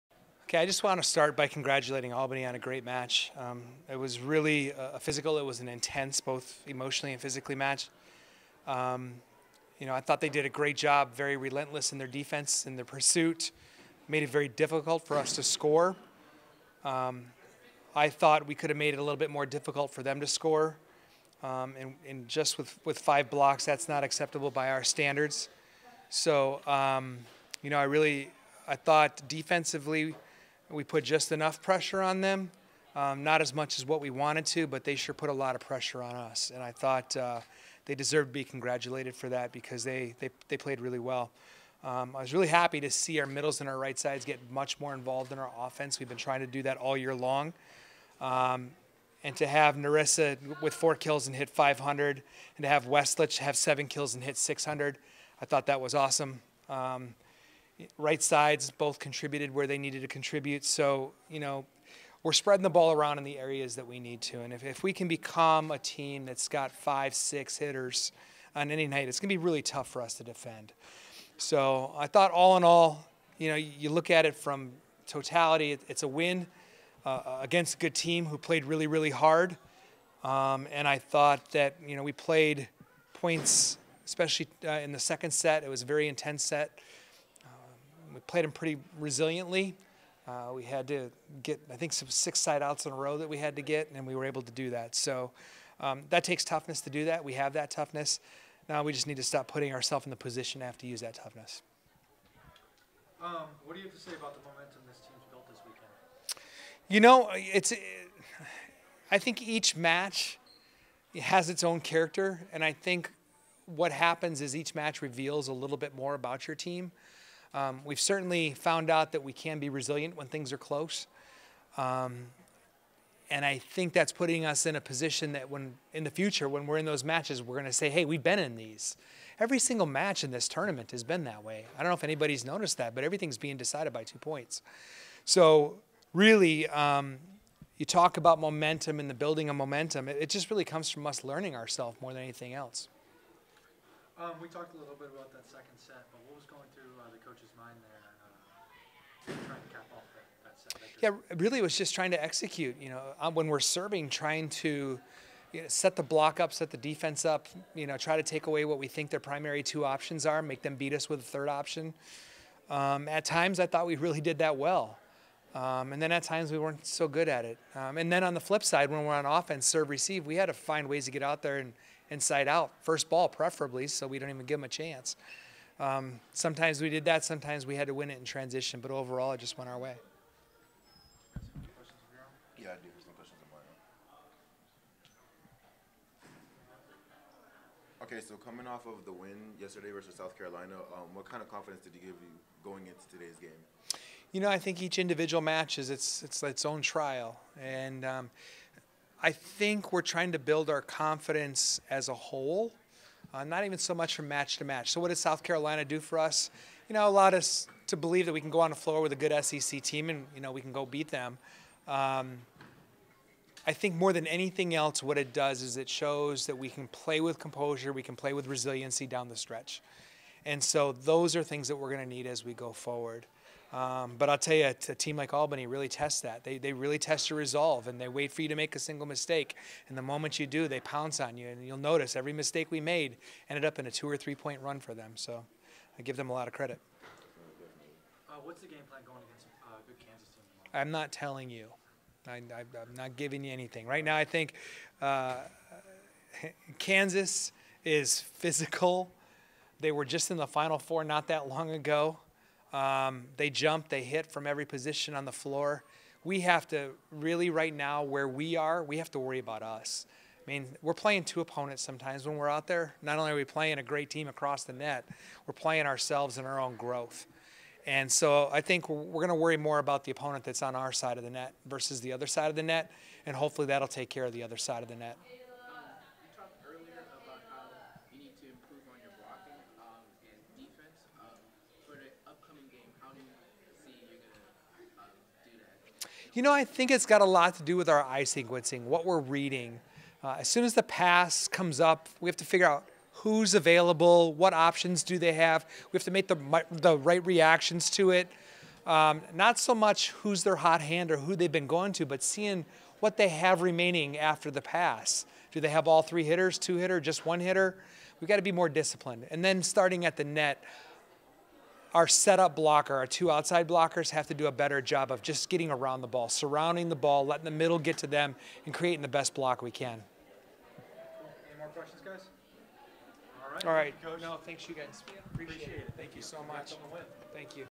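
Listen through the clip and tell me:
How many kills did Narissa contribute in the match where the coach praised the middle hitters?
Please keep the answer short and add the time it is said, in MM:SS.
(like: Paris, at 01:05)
4, at 00:50.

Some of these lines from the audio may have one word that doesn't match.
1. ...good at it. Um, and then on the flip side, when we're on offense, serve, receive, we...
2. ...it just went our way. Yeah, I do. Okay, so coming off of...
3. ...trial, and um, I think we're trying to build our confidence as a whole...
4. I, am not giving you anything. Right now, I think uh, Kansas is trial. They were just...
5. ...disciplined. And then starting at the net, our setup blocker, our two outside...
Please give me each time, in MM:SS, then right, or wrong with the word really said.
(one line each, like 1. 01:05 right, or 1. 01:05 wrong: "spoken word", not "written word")
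1. 02:47 right
2. 02:59 right
3. 03:16 right
4. 04:02 wrong: "physical", not "trial"
5. 05:08 right.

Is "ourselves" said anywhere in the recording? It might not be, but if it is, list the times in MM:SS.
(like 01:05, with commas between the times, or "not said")
01:39, 02:21, 04:25.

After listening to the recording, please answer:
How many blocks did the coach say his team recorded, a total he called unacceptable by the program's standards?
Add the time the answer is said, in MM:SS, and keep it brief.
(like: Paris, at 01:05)
5, at 00:22.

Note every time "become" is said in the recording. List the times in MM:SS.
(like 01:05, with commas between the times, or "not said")
01:05.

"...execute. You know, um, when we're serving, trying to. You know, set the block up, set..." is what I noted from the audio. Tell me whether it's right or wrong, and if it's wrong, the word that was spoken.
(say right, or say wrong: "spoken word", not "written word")
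right.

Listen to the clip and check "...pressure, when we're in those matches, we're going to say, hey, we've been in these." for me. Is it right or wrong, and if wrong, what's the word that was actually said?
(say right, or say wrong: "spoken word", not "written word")
wrong: "future", not "pressure".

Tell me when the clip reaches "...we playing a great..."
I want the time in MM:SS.
04:23.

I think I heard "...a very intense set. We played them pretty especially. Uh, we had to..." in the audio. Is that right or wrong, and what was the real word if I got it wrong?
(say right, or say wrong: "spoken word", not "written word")
wrong: "resiliently", not "especially".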